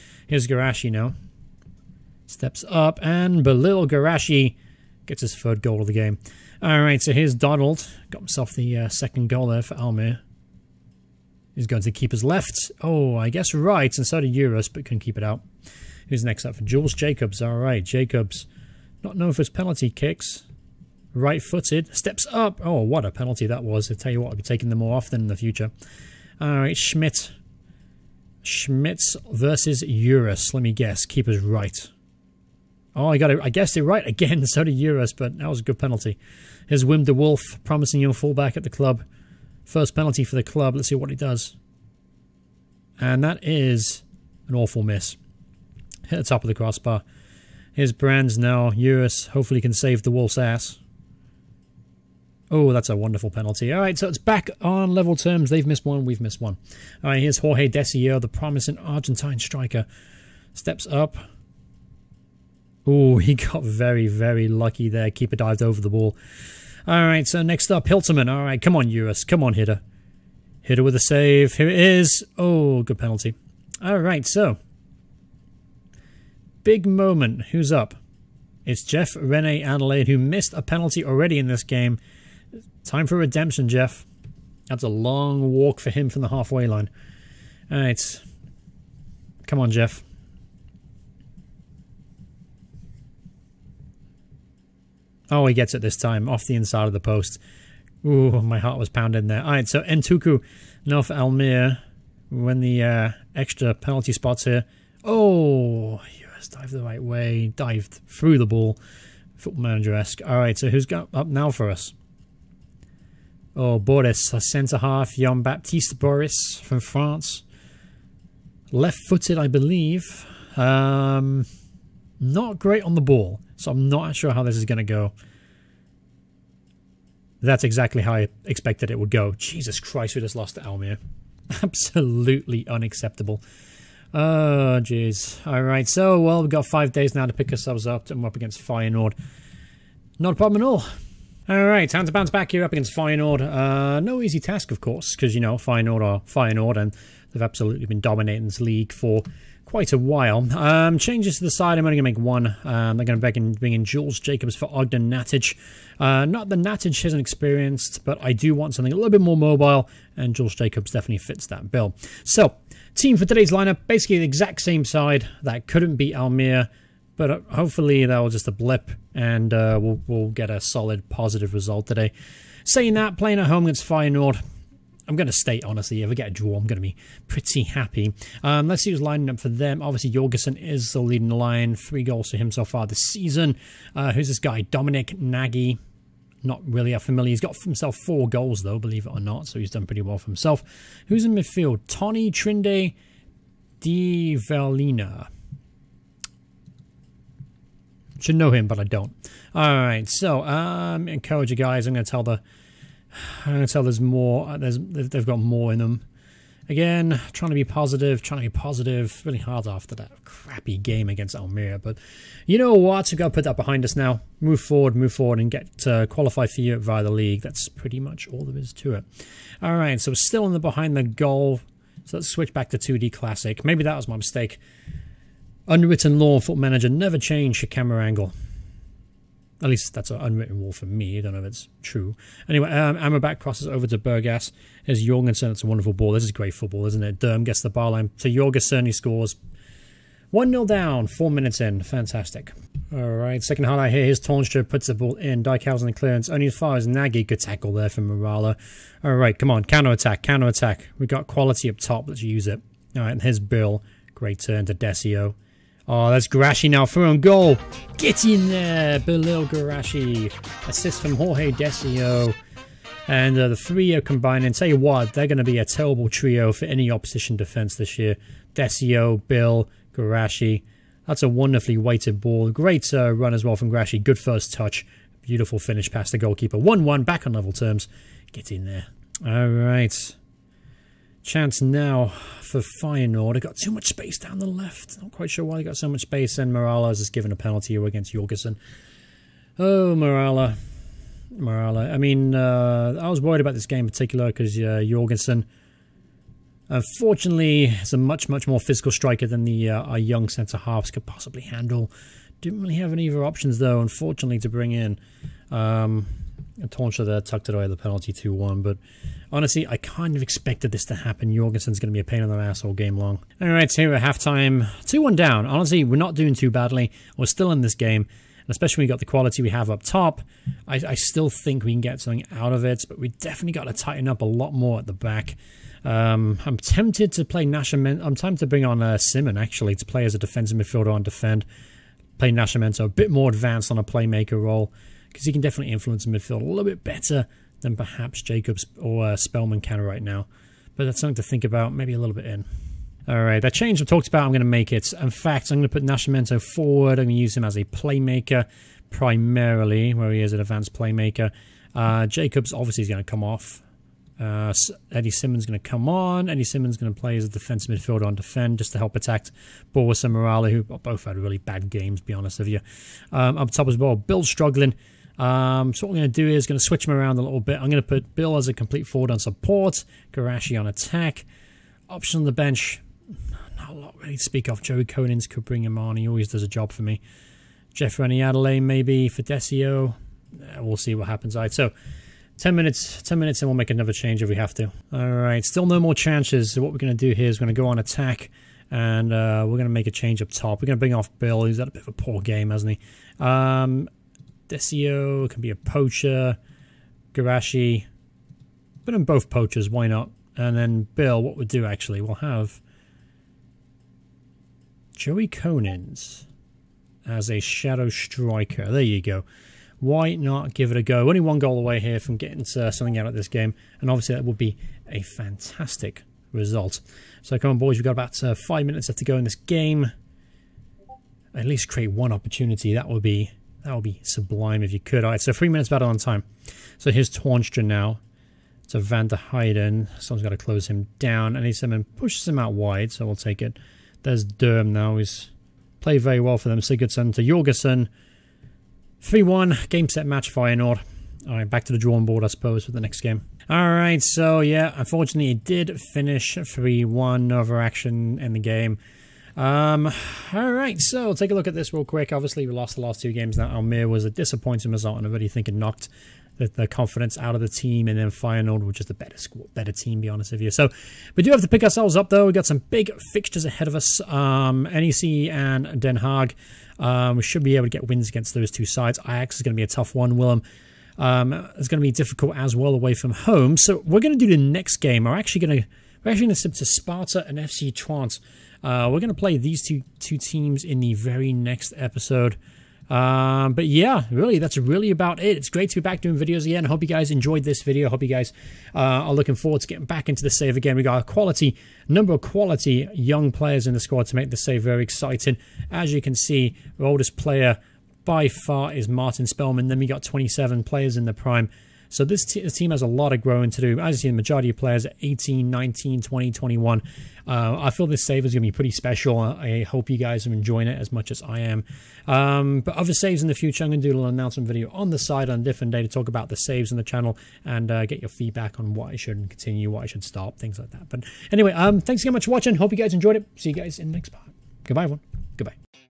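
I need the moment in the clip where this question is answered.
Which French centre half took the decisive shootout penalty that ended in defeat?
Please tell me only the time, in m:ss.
1:55.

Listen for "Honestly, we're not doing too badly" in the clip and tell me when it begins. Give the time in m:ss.
5:15.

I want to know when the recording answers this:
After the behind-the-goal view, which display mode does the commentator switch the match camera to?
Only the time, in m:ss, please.
3:42.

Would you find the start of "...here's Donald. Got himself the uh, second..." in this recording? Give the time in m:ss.
0:07.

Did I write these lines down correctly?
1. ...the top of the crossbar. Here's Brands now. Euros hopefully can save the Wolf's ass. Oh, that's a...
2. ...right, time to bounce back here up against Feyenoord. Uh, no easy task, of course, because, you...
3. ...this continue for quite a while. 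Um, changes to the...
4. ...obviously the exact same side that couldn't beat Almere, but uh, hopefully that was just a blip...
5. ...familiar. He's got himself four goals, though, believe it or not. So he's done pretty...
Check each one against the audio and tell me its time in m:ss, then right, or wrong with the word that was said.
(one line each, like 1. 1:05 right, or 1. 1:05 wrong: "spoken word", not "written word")
1. 0:46 right
2. 2:21 right
3. 2:28 wrong: "league", not "continue"
4. 2:43 wrong: "basically", not "obviously"
5. 3:06 right.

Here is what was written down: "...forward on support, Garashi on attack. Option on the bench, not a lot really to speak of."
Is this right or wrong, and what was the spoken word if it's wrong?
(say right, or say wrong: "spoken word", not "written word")
right.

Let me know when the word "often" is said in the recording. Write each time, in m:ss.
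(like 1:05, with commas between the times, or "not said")
0:24.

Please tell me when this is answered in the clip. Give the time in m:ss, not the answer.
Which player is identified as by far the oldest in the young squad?
8:18.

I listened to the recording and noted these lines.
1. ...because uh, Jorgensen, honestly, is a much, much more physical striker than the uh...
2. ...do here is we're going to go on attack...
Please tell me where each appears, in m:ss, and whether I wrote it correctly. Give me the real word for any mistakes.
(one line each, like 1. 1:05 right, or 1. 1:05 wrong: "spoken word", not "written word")
1. 4:54 wrong: "unfortunately", not "honestly"
2. 6:27 right.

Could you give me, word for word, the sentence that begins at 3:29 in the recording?
Really hard after that crappy game against Almeria, But you know what?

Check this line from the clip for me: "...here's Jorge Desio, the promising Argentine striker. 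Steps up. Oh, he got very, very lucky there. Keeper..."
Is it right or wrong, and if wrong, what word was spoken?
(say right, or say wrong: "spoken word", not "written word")
right.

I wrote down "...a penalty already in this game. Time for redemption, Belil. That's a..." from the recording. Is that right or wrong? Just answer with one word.
wrong.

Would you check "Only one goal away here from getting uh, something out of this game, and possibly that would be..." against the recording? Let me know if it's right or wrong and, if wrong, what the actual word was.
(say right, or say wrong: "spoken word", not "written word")
wrong: "obviously", not "possibly".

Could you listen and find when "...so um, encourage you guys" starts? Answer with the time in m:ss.
3:20.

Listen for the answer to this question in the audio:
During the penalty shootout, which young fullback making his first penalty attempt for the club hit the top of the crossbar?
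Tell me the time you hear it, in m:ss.
0:36.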